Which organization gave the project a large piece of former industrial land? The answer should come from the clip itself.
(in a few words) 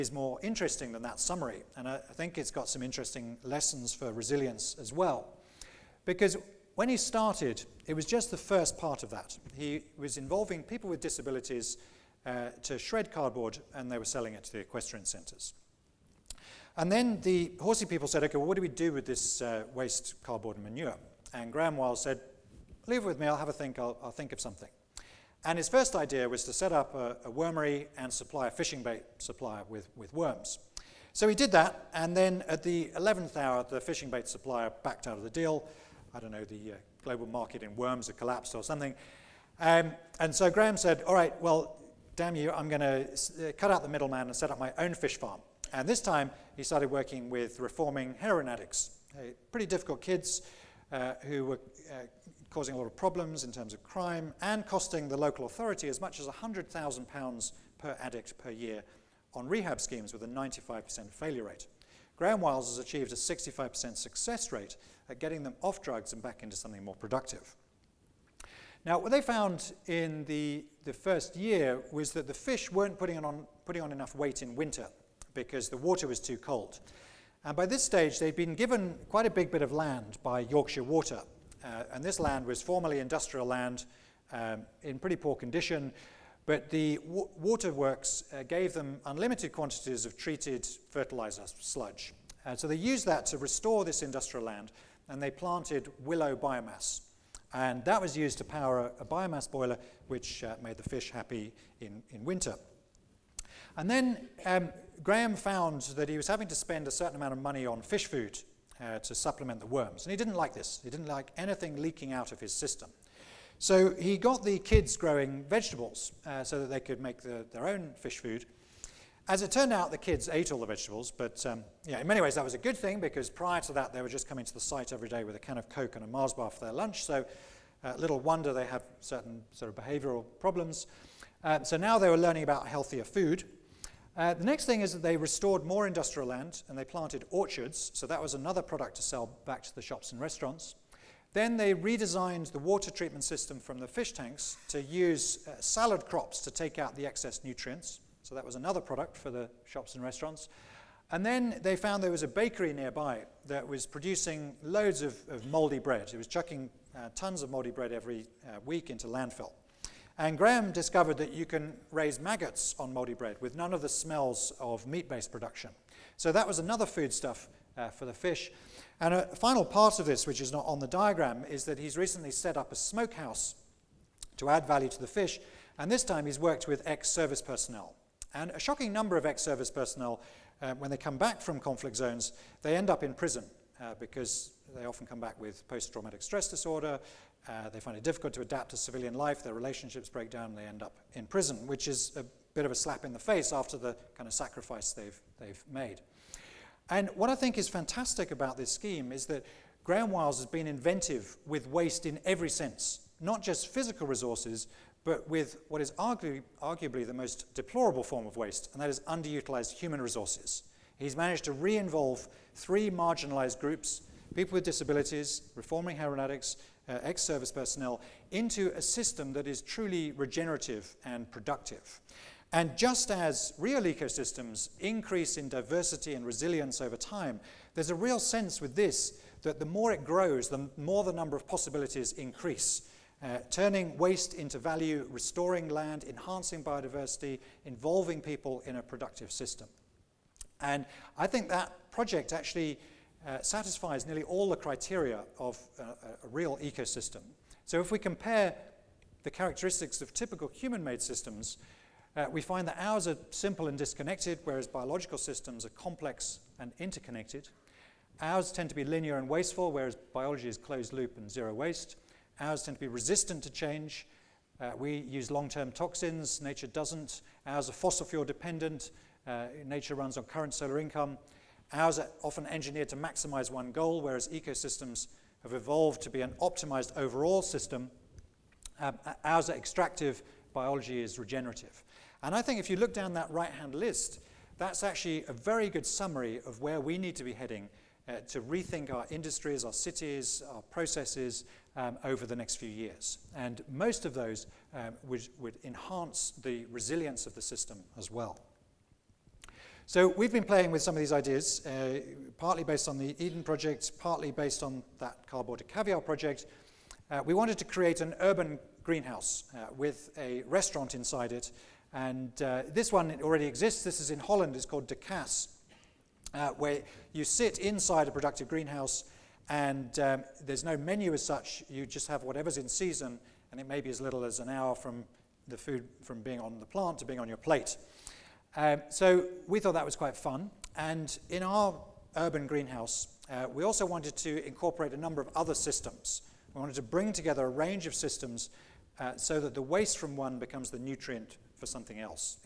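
Yorkshire Water.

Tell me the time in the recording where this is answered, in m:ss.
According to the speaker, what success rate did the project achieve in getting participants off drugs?
1:03.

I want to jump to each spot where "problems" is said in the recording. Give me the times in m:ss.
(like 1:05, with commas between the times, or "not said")
0:52, 2:10.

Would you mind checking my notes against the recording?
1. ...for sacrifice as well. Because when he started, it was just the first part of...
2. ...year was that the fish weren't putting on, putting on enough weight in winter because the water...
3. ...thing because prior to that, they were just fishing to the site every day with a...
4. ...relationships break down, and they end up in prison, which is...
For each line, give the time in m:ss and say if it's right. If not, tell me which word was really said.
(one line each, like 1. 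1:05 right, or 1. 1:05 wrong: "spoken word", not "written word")
1. 0:03 wrong: "resilience", not "sacrifice"
2. 1:11 right
3. 2:02 wrong: "coming", not "fishing"
4. 3:09 right.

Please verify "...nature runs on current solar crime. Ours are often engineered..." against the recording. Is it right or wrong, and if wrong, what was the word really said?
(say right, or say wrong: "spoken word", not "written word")
wrong: "income", not "crime".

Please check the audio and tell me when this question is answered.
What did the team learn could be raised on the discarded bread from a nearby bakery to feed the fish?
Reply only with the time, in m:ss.
2:42.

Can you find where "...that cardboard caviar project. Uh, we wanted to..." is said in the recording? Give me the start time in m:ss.
5:04.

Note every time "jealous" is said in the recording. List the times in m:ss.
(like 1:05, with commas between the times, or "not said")
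not said.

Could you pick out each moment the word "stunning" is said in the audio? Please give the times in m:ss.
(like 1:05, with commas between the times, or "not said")
not said.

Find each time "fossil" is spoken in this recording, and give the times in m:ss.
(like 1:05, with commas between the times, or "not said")
4:27.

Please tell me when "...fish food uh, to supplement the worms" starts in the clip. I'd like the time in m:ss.
1:47.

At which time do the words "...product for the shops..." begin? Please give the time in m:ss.
2:28.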